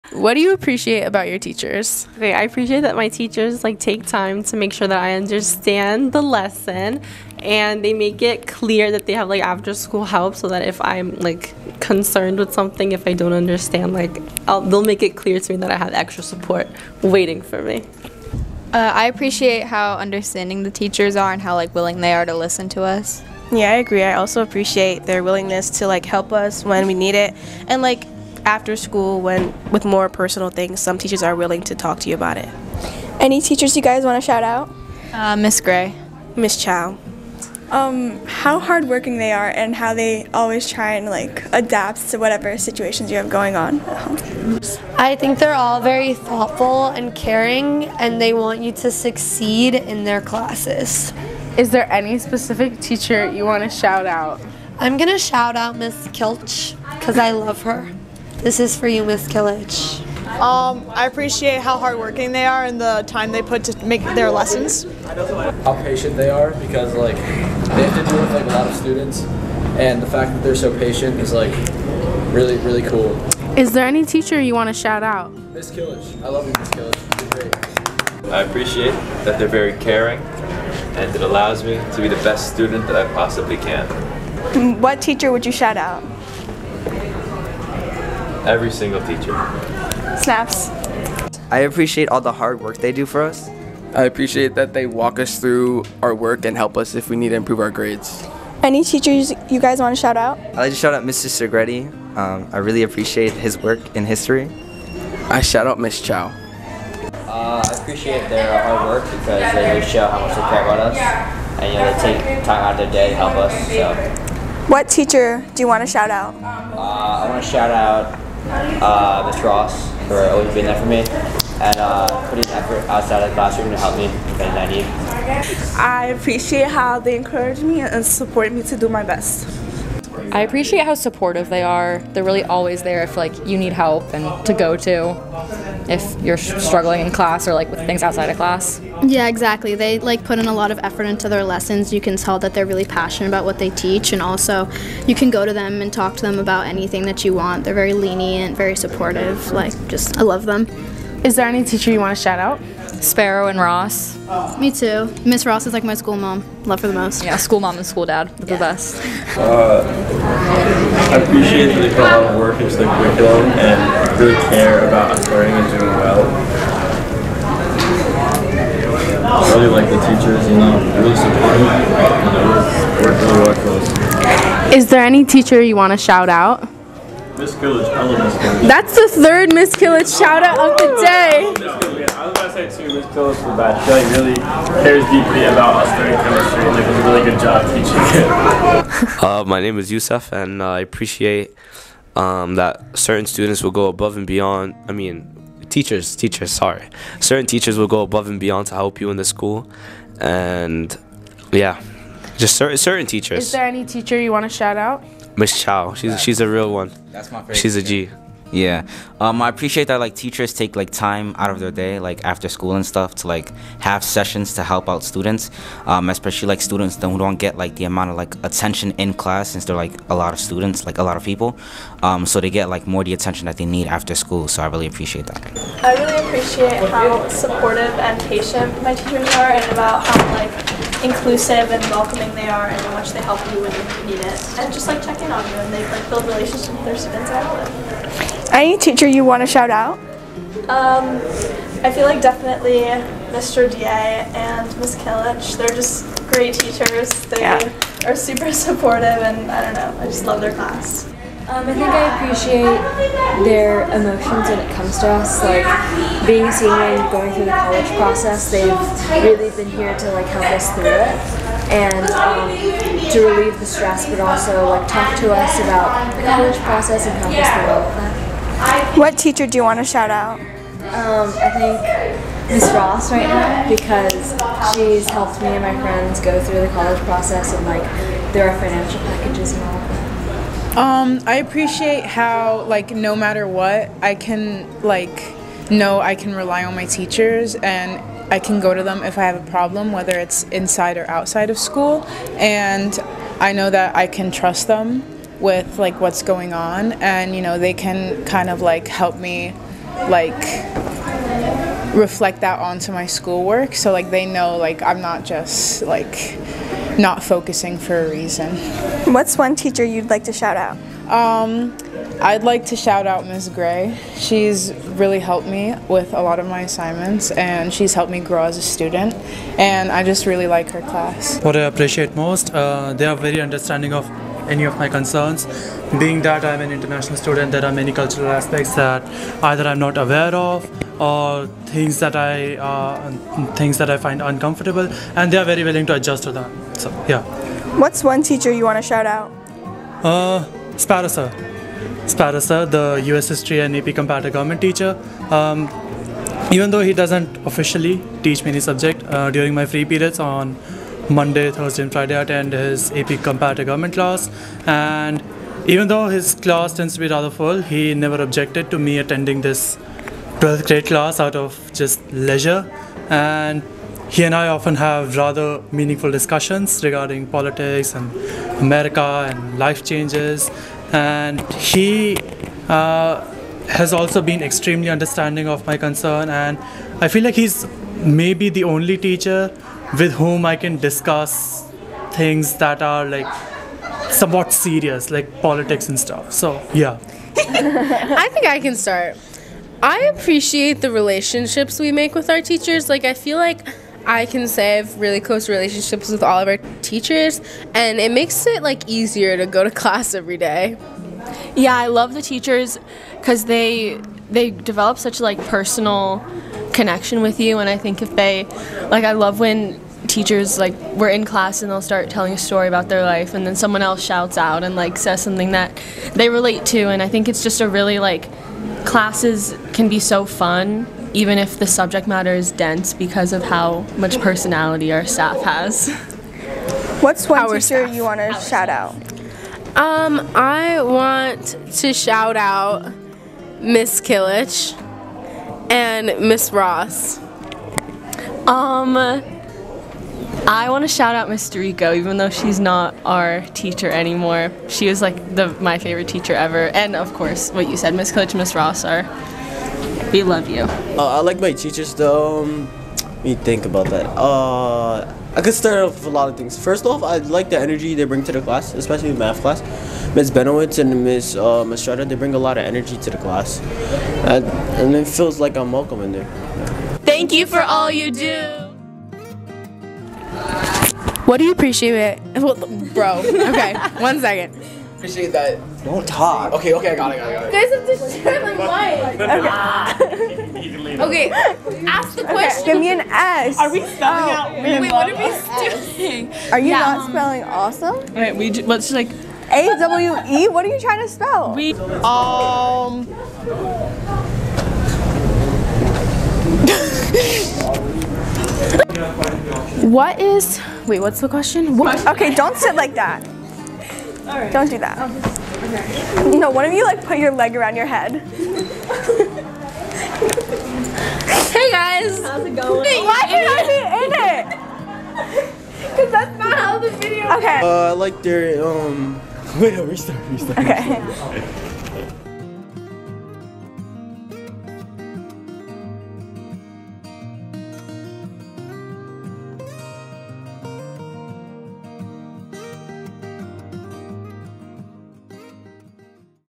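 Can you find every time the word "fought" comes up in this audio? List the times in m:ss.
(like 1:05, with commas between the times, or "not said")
not said.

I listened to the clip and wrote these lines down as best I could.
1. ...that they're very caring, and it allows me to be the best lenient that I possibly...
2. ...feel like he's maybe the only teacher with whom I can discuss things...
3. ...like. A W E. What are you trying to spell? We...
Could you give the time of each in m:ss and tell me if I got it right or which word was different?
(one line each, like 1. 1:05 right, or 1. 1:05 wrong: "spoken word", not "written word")
1. 1:19 wrong: "student", not "lenient"
2. 6:17 right
3. 8:08 right.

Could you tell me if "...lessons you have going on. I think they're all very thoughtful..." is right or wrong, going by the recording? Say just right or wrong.
wrong.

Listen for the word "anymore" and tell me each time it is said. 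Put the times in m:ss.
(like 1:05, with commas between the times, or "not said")
7:23.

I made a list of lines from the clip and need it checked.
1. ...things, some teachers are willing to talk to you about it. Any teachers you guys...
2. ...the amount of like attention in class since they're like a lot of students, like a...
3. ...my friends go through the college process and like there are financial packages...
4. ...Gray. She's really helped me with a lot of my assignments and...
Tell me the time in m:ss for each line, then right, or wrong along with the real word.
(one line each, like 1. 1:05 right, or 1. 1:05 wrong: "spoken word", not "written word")
1. 0:30 right
2. 3:37 right
3. 4:35 right
4. 5:13 right.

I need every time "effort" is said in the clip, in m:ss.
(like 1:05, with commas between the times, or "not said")
2:02, 2:20.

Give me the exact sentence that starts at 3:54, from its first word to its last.
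And just like check in on you and they like build relationships with their students I Outlet.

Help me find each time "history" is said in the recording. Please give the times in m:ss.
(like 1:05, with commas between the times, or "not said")
1:44, 5:43.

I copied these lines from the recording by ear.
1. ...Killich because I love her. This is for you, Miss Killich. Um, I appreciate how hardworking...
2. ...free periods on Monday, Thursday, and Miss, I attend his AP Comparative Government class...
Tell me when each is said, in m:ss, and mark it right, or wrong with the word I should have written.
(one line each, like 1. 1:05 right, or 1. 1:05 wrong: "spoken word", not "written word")
1. 0:56 right
2. 5:49 wrong: "Friday", not "Miss".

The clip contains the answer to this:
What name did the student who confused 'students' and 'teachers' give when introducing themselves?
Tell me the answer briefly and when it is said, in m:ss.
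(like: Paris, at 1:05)
Yusuf, at 3:09.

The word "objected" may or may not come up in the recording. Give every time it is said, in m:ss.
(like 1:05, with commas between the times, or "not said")
5:58.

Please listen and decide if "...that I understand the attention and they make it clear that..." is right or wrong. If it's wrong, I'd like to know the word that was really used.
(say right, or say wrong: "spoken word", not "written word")
wrong: "lesson", not "attention".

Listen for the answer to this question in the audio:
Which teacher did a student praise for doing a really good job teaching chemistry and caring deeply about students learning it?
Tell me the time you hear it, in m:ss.
3:02.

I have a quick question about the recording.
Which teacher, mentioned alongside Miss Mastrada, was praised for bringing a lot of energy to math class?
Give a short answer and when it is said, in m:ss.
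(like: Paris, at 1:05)
Miss Benowitz, at 7:40.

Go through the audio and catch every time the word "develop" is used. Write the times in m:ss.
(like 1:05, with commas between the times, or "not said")
6:44.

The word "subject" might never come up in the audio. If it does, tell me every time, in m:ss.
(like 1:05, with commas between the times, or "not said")
5:48, 7:01.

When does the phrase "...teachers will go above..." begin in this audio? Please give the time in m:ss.
3:17.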